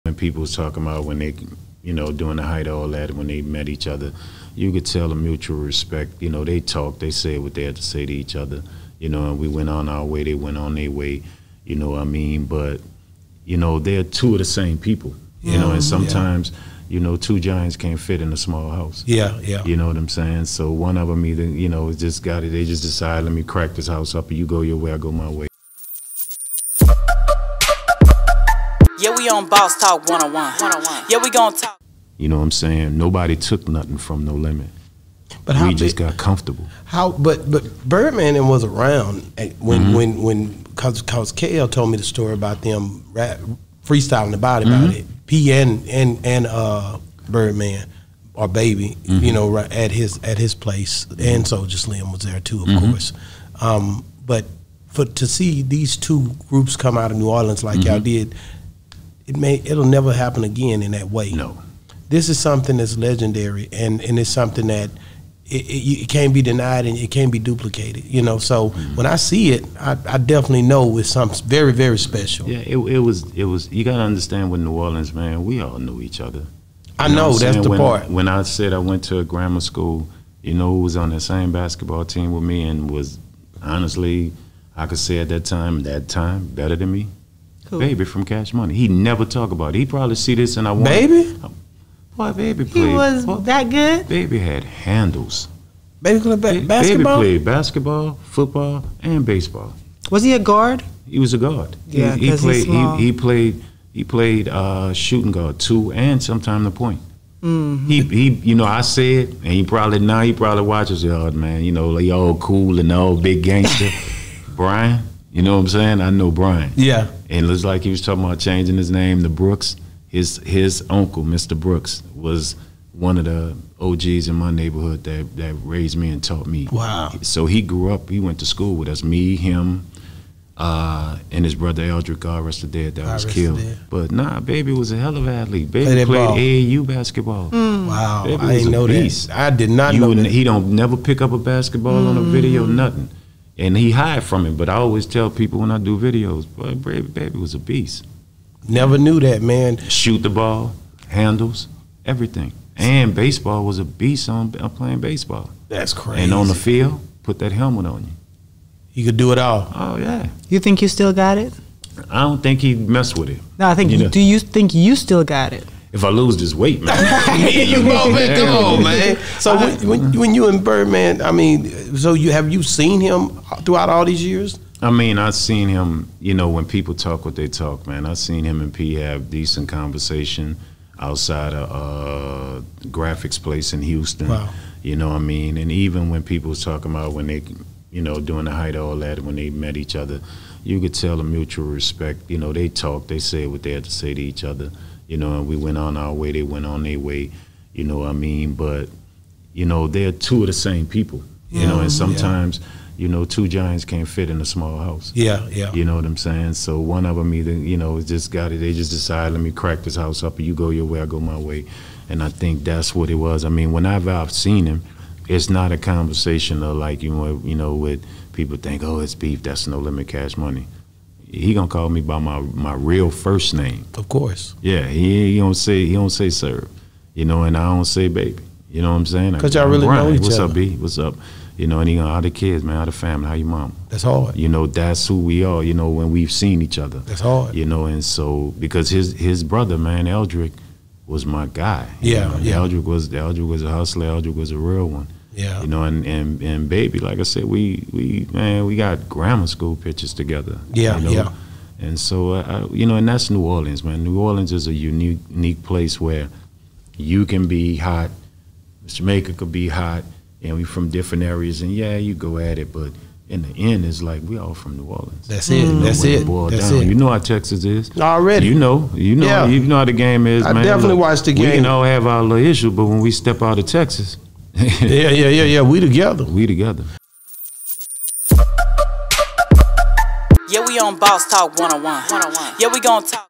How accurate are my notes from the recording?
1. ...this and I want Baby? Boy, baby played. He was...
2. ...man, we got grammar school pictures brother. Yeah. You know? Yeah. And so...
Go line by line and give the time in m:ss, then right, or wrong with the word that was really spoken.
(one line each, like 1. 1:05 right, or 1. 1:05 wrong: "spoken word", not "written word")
1. 1:30 right
2. 4:08 wrong: "together", not "brother".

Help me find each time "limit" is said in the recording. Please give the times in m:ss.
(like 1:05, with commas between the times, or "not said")
0:34, 3:39.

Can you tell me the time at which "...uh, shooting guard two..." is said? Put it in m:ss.
1:44.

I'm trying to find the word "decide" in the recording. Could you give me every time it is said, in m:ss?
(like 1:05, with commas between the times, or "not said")
0:22, 3:28.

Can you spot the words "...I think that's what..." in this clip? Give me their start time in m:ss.
3:32.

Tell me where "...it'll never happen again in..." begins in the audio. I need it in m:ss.
0:59.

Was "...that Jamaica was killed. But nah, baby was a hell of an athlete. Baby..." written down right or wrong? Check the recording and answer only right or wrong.
wrong.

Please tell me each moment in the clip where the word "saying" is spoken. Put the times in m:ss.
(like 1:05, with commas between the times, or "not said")
0:20, 0:32, 1:55, 3:26, 3:49.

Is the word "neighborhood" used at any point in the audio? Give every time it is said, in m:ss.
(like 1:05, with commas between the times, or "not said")
2:04.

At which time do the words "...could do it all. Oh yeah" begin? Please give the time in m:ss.
2:39.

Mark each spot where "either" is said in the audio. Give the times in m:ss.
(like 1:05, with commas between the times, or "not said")
0:21, 3:27.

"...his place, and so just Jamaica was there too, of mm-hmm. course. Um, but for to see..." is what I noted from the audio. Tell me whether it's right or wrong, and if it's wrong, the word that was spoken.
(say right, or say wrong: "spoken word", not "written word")
wrong: "Slim", not "Jamaica".